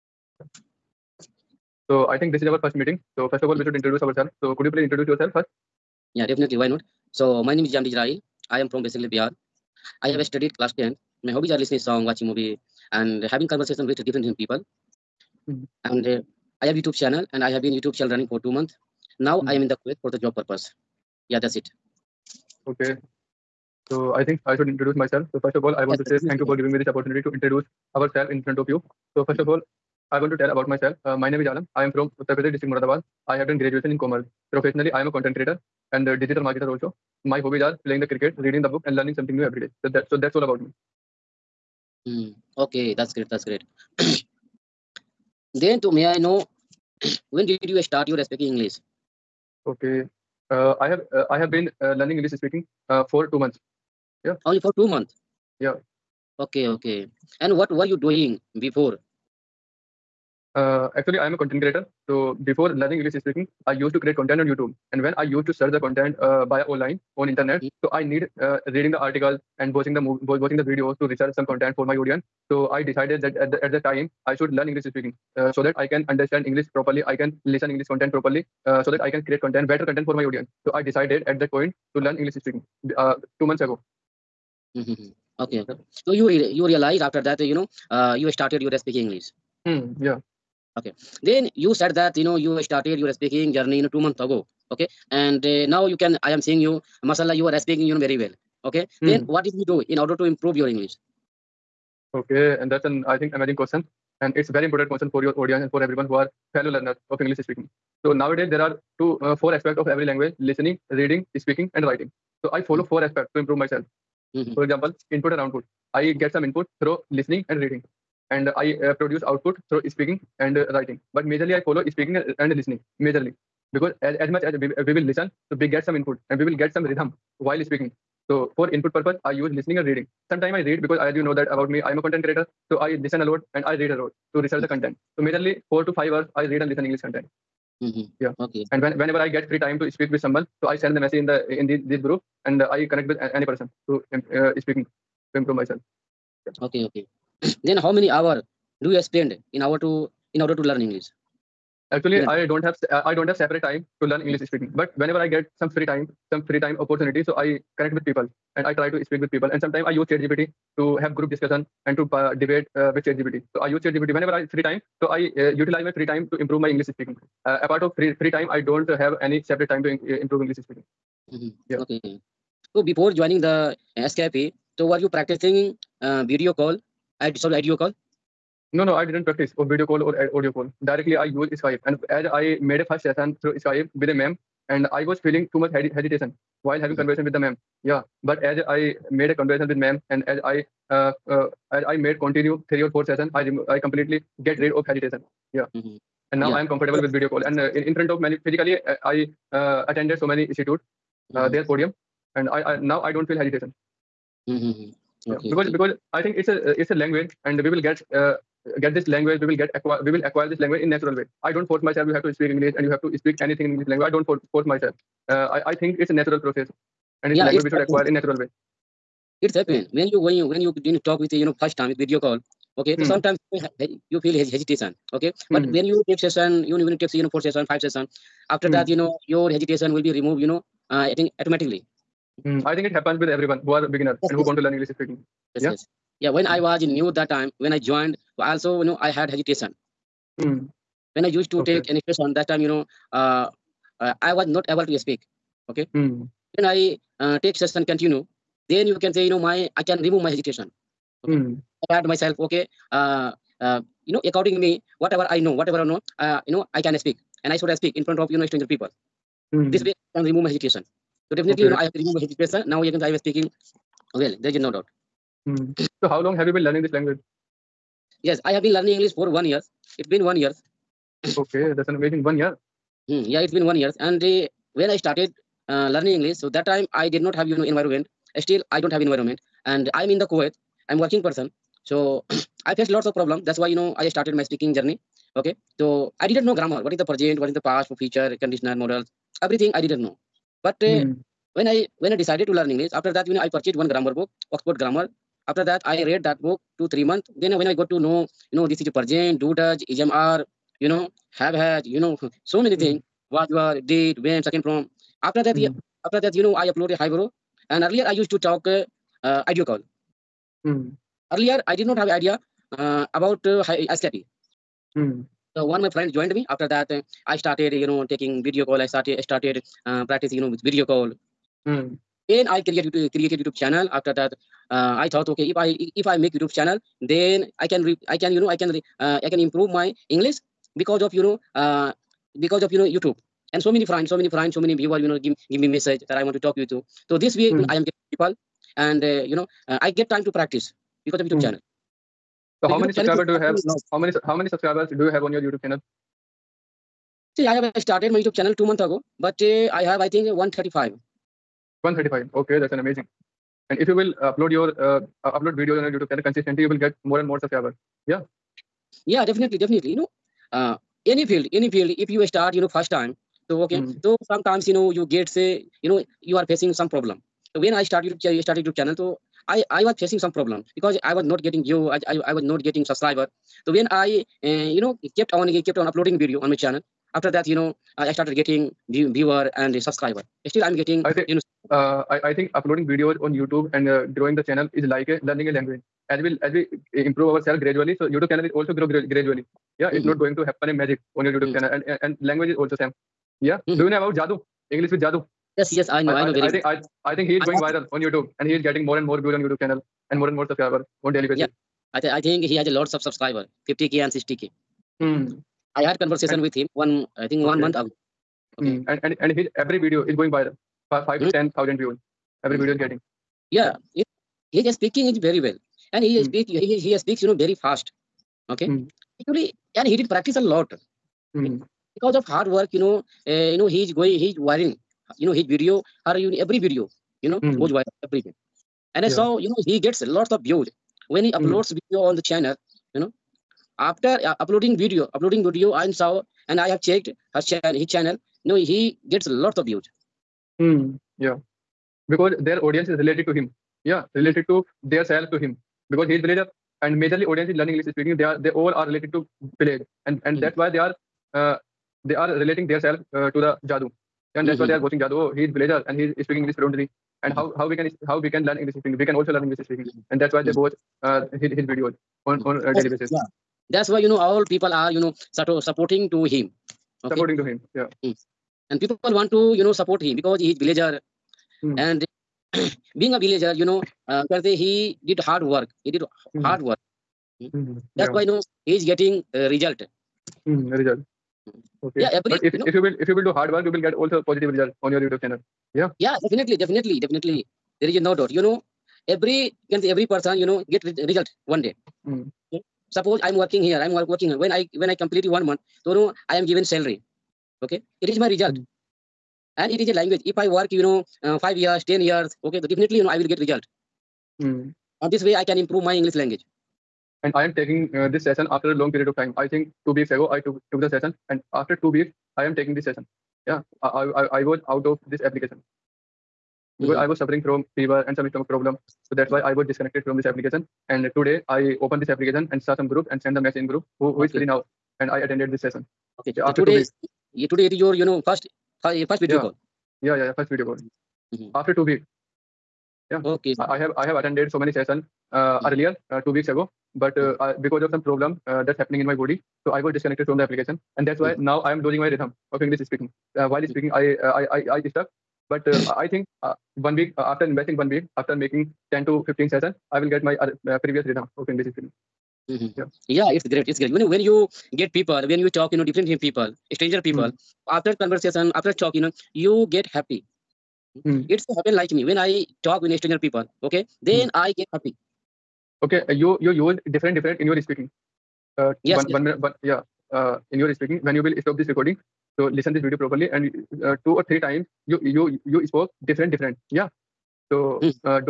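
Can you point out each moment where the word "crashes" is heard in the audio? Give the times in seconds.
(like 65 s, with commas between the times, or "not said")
not said.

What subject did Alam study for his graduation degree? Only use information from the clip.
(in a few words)
Commerce.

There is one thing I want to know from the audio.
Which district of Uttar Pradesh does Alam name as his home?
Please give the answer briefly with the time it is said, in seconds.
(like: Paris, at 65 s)
Muradabad, at 32 s.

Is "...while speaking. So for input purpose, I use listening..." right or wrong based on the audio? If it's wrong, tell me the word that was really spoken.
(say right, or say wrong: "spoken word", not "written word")
right.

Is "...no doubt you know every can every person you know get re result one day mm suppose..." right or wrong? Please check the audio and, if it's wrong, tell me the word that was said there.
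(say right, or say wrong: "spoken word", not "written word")
right.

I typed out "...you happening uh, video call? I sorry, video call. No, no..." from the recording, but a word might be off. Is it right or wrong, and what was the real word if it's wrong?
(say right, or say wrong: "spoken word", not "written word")
wrong: "practicing", not "happening".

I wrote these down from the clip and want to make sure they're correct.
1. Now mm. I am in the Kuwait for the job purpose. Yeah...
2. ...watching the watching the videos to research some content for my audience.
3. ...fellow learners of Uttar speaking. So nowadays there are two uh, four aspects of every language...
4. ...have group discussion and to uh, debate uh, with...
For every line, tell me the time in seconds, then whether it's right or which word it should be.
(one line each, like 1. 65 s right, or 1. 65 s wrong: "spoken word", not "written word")
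1. 19 s right
2. 69 s right
3. 106 s wrong: "English", not "Uttar"
4. 160 s right.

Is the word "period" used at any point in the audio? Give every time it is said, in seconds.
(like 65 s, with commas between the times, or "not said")
508 s.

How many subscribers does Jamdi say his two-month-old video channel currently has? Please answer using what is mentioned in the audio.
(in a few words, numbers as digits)
135.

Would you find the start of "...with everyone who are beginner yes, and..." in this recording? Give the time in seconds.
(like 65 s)
233 s.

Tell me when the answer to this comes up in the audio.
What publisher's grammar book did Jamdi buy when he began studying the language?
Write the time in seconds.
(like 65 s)
294 s.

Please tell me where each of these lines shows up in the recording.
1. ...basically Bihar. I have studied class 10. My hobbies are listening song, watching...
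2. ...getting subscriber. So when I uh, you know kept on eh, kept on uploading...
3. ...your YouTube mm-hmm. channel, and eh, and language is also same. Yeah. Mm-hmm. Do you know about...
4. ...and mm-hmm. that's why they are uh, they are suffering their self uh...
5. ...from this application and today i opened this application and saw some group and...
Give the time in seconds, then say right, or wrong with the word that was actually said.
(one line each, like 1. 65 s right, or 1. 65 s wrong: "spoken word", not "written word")
1. 8 s right
2. 372 s right
3. 391 s right
4. 450 s wrong: "relating", not "suffering"
5. 520 s right.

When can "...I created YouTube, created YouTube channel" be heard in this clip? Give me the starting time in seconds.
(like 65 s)
322 s.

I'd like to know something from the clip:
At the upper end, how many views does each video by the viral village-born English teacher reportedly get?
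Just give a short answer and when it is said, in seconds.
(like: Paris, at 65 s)
10,000, at 411 s.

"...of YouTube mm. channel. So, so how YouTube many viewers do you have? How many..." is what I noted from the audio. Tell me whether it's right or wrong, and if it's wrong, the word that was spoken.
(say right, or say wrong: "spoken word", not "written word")
wrong: "subscribers", not "viewers".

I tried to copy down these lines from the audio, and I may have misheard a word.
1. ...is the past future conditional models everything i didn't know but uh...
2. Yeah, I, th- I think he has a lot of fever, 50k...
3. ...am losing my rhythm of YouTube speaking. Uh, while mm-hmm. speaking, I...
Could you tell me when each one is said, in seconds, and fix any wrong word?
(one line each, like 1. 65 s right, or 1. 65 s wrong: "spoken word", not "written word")
1. 287 s right
2. 401 s wrong: "subscriber", not "fever"
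3. 541 s wrong: "English", not "YouTube".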